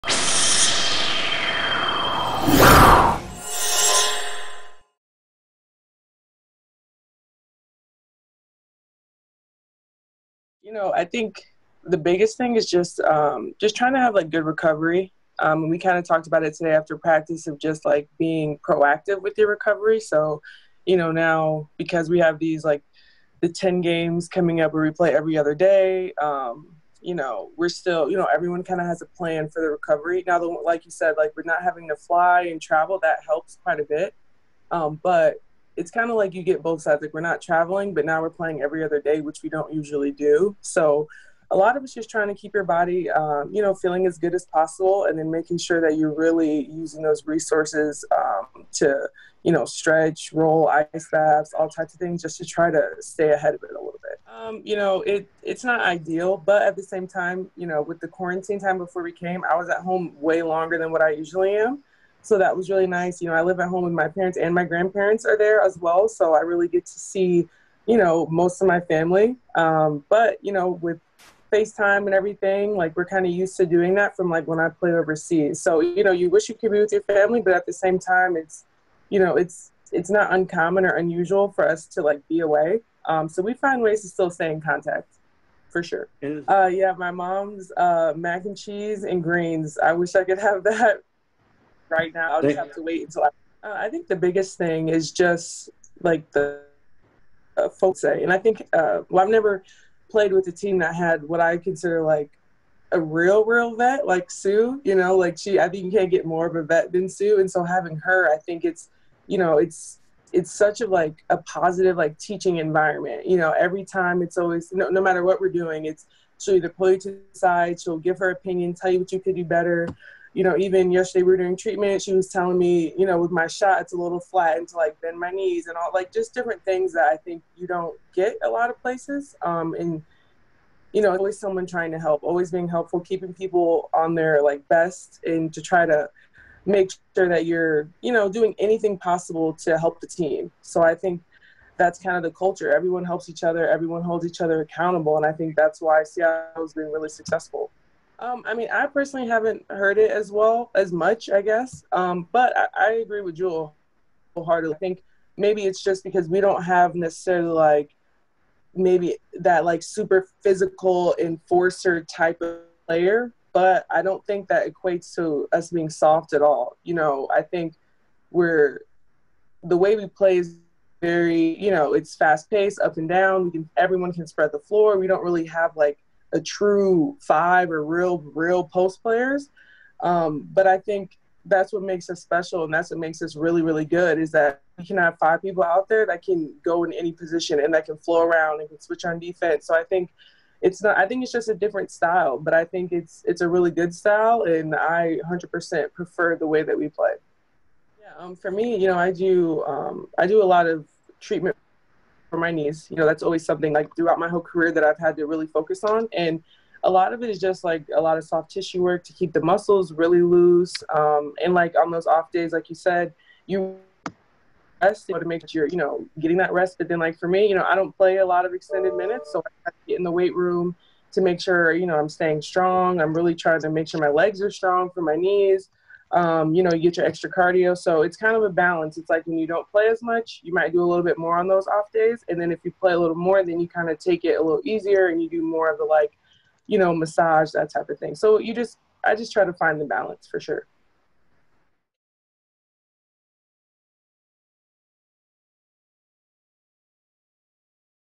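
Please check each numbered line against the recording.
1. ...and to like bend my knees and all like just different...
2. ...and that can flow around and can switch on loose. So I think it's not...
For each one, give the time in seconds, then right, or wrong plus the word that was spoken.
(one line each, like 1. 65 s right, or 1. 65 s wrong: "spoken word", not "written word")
1. 124 s right
2. 187 s wrong: "defense", not "loose".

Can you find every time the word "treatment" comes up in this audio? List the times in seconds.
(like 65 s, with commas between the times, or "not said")
121 s, 201 s.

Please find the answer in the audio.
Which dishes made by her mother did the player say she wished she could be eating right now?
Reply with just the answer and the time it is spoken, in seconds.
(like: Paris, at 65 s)
Mac and cheese and greens, at 88 s.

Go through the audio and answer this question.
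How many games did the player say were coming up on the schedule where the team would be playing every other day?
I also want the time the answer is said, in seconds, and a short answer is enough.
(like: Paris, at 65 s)
10, at 23 s.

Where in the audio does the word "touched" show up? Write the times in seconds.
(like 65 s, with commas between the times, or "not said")
not said.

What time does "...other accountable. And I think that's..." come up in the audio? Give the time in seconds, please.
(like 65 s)
144 s.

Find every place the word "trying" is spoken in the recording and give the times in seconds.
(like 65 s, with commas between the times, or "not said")
13 s, 42 s, 131 s, 223 s.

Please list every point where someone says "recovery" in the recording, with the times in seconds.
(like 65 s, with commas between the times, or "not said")
14 s, 19 s, 29 s.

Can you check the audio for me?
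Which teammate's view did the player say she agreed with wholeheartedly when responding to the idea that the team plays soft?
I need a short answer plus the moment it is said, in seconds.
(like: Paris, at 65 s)
Jewell, at 153 s.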